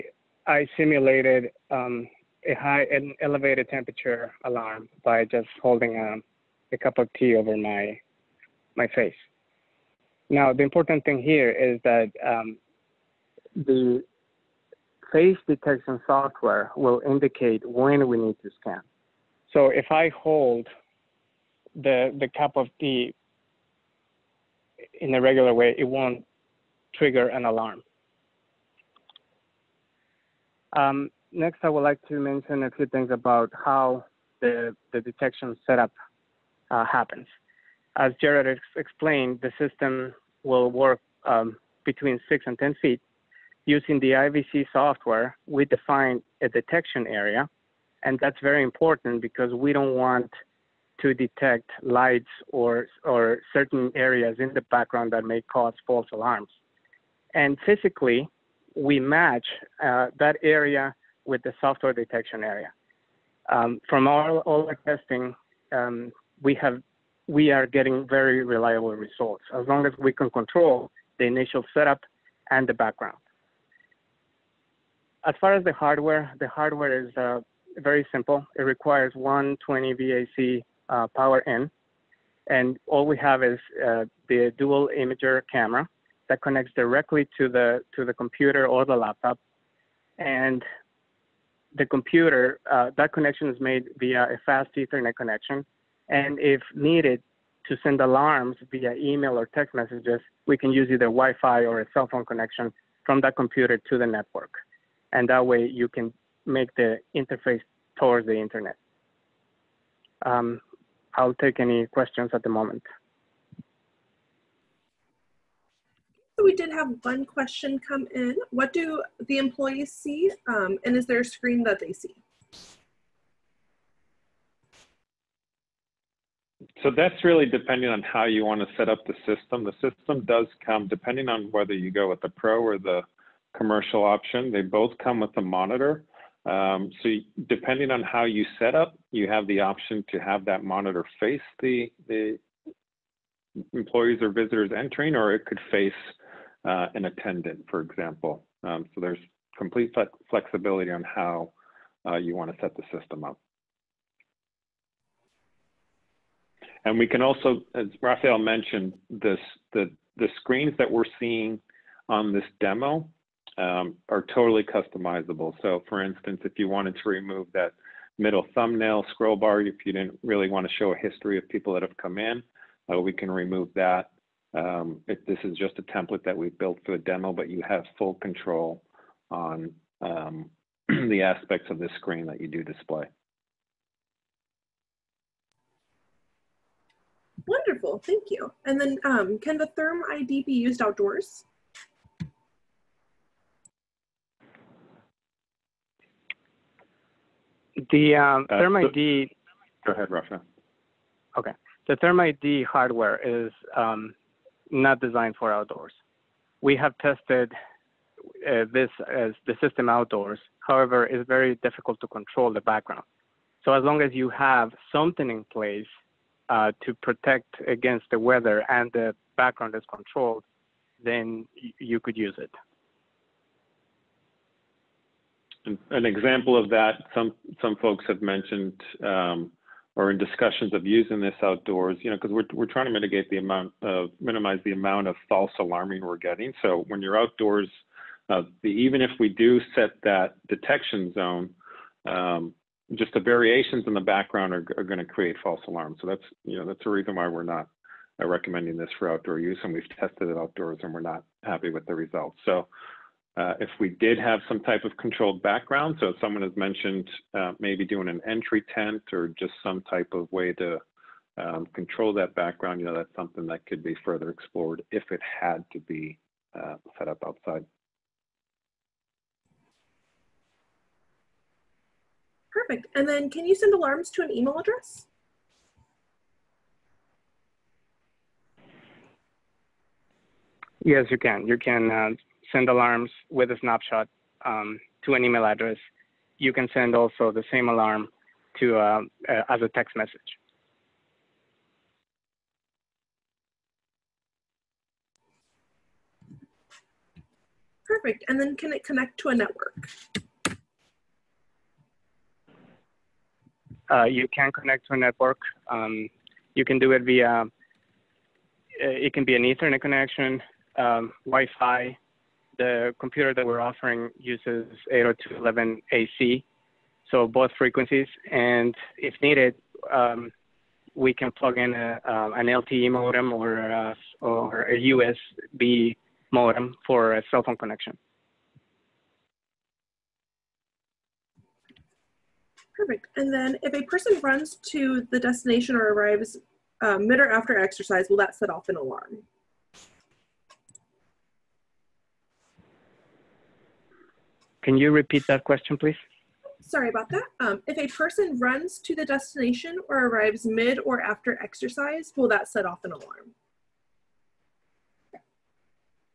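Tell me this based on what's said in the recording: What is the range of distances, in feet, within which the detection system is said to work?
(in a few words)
6 and 10 feet.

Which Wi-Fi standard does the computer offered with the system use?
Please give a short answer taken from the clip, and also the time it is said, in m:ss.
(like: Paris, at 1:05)
802.11 AC, at 5:14.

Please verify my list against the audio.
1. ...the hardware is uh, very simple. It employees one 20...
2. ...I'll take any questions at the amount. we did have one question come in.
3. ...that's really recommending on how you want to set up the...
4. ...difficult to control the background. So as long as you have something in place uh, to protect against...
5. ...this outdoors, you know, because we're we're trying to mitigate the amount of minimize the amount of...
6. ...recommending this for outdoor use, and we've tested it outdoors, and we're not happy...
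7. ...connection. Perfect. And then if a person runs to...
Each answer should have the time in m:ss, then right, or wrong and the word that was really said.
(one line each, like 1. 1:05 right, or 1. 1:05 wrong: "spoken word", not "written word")
1. 1:16 wrong: "requires", not "employees"
2. 1:51 wrong: "moment", not "amount"
3. 2:06 wrong: "depending", not "recommending"
4. 3:31 right
5. 3:51 right
6. 4:08 right
7. 5:27 right.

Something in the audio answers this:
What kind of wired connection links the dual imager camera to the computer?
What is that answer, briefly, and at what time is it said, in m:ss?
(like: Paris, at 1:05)
fast Ethernet, at 1:34.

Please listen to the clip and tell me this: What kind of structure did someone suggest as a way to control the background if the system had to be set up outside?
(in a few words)
entry tent.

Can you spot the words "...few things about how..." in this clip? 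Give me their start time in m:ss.
0:32.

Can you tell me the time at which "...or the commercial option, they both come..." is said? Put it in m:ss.
2:12.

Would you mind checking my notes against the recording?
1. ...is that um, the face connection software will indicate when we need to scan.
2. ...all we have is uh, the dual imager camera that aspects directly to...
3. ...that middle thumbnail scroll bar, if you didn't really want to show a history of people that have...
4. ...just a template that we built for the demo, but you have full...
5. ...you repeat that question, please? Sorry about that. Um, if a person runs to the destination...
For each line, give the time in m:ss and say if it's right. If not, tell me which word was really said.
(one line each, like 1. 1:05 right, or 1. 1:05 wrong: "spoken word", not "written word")
1. 0:11 wrong: "detection", not "connection"
2. 1:22 wrong: "connects", not "aspects"
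3. 2:47 right
4. 2:55 right
5. 5:44 right.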